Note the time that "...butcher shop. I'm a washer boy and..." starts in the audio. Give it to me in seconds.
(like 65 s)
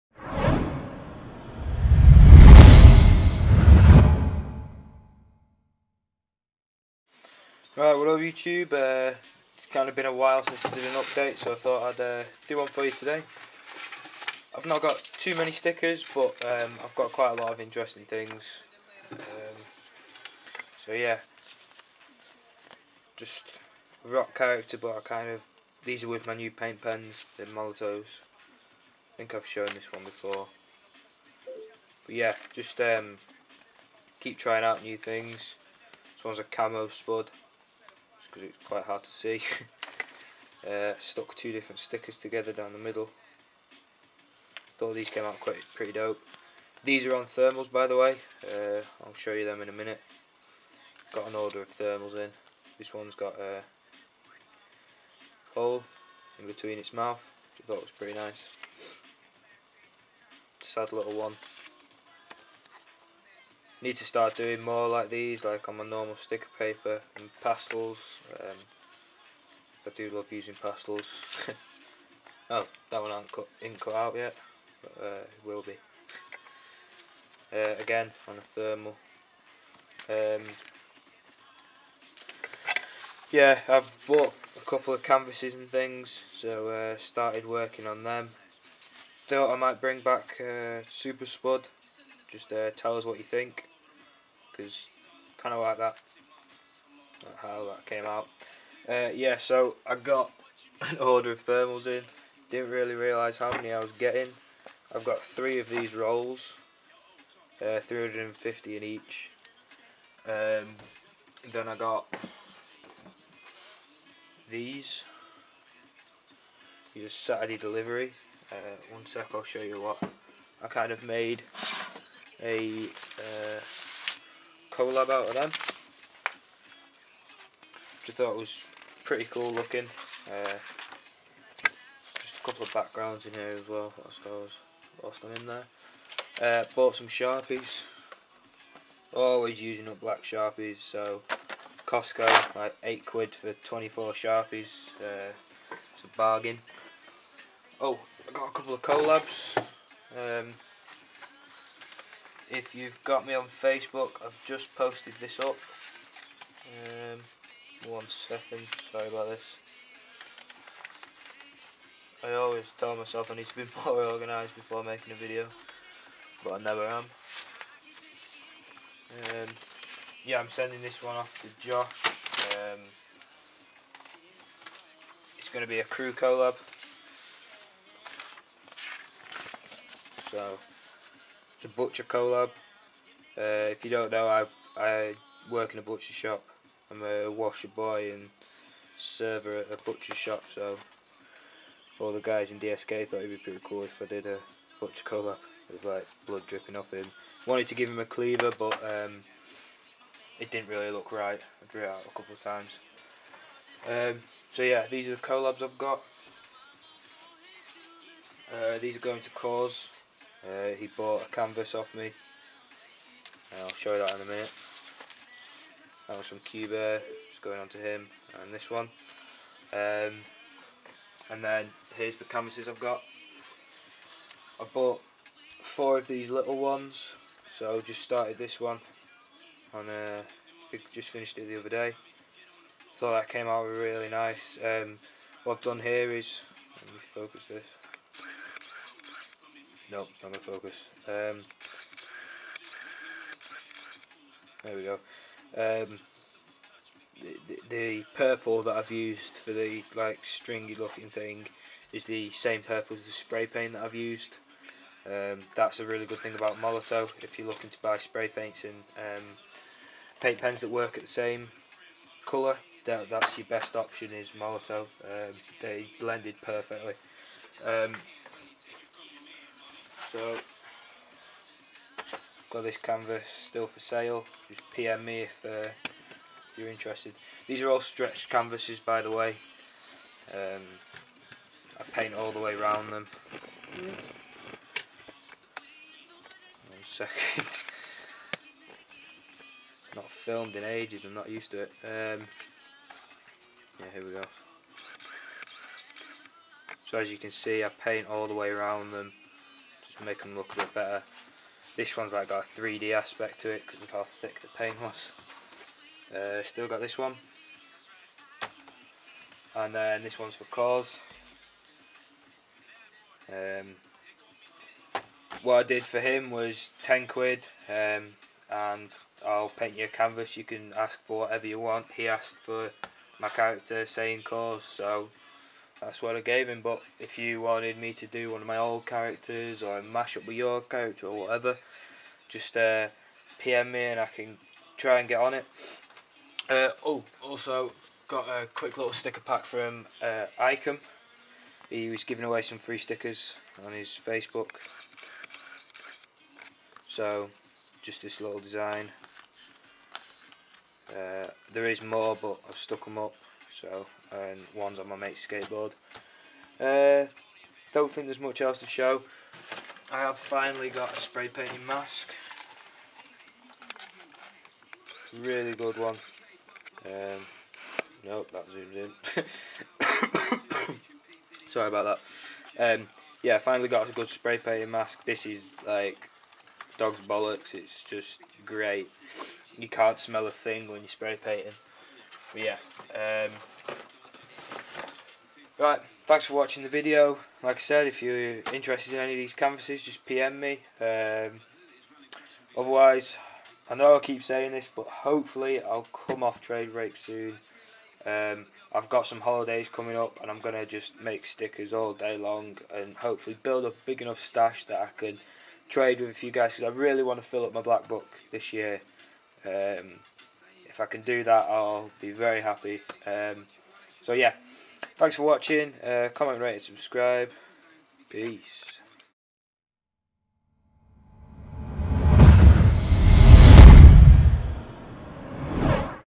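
185 s.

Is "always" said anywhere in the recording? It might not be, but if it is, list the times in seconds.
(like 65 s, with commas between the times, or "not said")
139 s, 162 s.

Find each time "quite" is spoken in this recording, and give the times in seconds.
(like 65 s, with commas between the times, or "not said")
17 s, 38 s, 45 s.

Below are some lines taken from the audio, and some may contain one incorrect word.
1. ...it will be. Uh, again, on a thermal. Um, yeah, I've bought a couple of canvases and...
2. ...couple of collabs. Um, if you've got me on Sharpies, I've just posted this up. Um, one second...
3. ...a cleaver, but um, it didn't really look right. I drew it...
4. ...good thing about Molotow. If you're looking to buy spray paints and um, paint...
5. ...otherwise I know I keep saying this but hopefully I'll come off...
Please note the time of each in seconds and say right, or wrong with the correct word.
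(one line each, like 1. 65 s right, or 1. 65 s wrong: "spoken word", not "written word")
1. 75 s right
2. 148 s wrong: "Facebook", not "Sharpies"
3. 197 s right
4. 256 s right
5. 392 s right.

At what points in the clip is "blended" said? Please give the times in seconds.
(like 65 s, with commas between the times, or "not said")
265 s.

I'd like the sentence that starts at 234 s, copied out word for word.
Um, what I've done here is, let me focus this.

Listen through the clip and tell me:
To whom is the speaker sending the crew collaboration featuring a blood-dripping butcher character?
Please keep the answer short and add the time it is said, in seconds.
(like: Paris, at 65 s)
Josh, at 171 s.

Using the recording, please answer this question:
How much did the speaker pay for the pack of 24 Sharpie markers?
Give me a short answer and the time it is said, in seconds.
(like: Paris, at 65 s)
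8 quid, at 142 s.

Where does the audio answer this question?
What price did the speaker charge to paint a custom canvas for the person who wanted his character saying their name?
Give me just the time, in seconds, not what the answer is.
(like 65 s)
316 s.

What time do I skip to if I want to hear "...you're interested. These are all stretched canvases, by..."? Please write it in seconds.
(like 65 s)
276 s.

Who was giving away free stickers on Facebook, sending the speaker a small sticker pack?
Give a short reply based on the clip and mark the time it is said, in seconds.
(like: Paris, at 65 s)
Icom, at 340 s.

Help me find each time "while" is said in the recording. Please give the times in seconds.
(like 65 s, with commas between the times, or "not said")
10 s.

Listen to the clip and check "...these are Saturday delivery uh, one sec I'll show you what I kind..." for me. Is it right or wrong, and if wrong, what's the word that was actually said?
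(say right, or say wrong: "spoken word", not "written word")
right.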